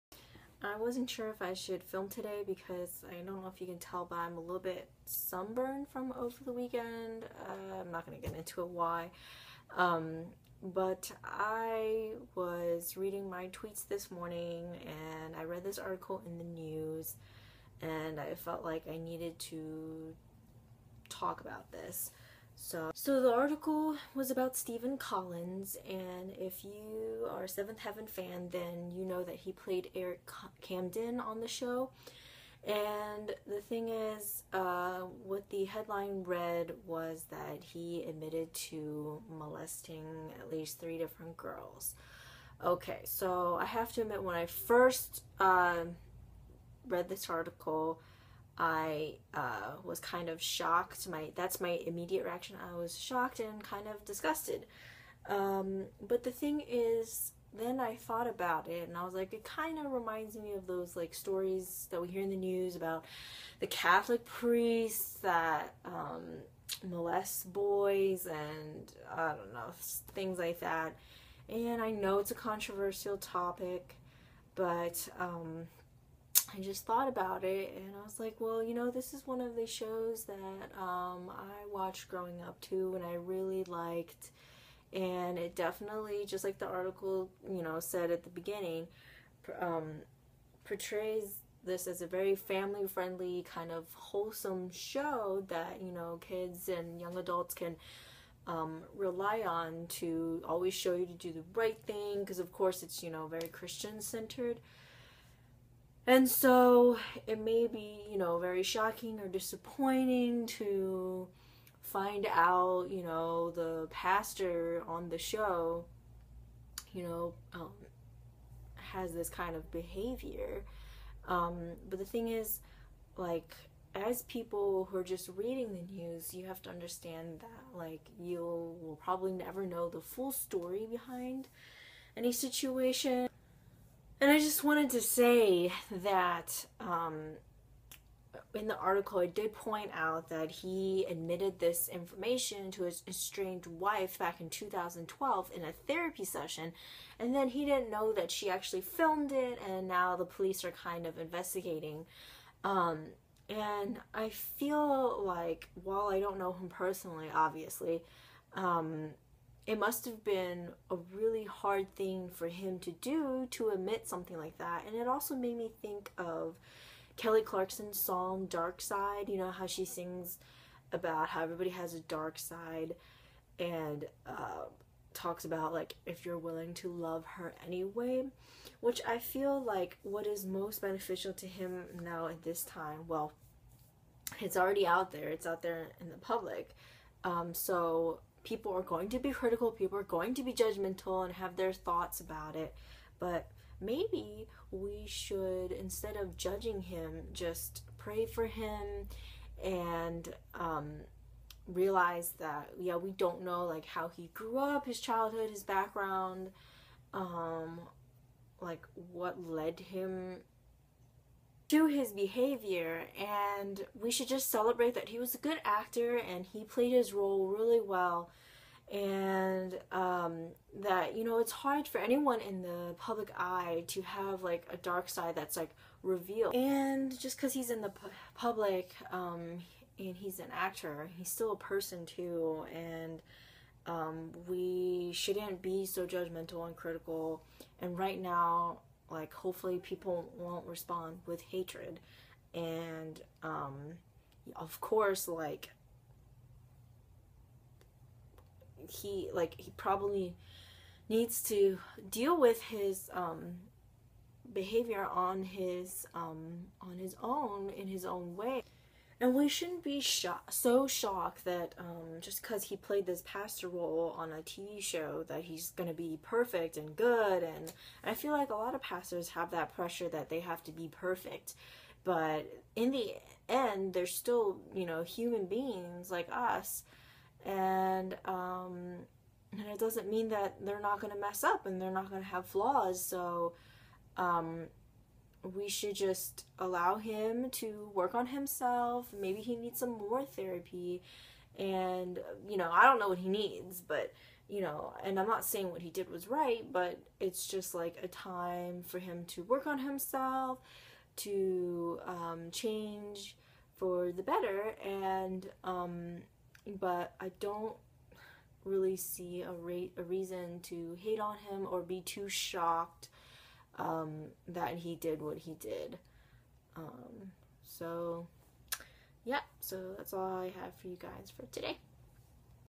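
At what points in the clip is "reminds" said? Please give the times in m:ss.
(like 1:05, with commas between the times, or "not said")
0:59.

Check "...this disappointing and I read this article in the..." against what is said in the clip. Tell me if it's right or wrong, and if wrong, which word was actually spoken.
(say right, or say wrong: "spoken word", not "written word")
wrong: "morning", not "disappointing".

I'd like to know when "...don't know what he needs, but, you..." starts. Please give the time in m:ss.
4:52.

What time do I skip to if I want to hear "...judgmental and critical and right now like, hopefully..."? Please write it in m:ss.
3:56.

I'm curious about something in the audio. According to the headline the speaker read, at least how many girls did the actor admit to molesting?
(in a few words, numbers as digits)
3.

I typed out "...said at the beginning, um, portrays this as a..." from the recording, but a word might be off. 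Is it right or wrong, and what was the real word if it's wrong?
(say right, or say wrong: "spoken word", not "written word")
right.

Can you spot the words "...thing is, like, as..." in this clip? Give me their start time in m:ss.
2:02.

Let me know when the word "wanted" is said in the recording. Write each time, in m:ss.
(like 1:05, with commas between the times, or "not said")
2:14.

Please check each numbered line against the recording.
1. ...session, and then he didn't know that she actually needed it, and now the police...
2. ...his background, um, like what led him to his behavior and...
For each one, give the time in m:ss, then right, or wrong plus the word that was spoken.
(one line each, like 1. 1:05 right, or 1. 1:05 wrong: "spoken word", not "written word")
1. 2:26 wrong: "filmed", not "needed"
2. 3:25 right.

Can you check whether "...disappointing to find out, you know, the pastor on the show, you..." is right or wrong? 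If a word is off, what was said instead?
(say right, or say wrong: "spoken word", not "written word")
right.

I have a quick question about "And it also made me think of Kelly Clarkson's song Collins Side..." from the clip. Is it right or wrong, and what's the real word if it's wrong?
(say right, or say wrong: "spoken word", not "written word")
wrong: "Dark", not "Collins".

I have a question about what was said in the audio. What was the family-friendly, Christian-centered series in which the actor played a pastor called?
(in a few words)
Seventh Heaven.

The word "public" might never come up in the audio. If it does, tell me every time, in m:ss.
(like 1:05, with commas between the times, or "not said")
3:06, 3:42, 3:48.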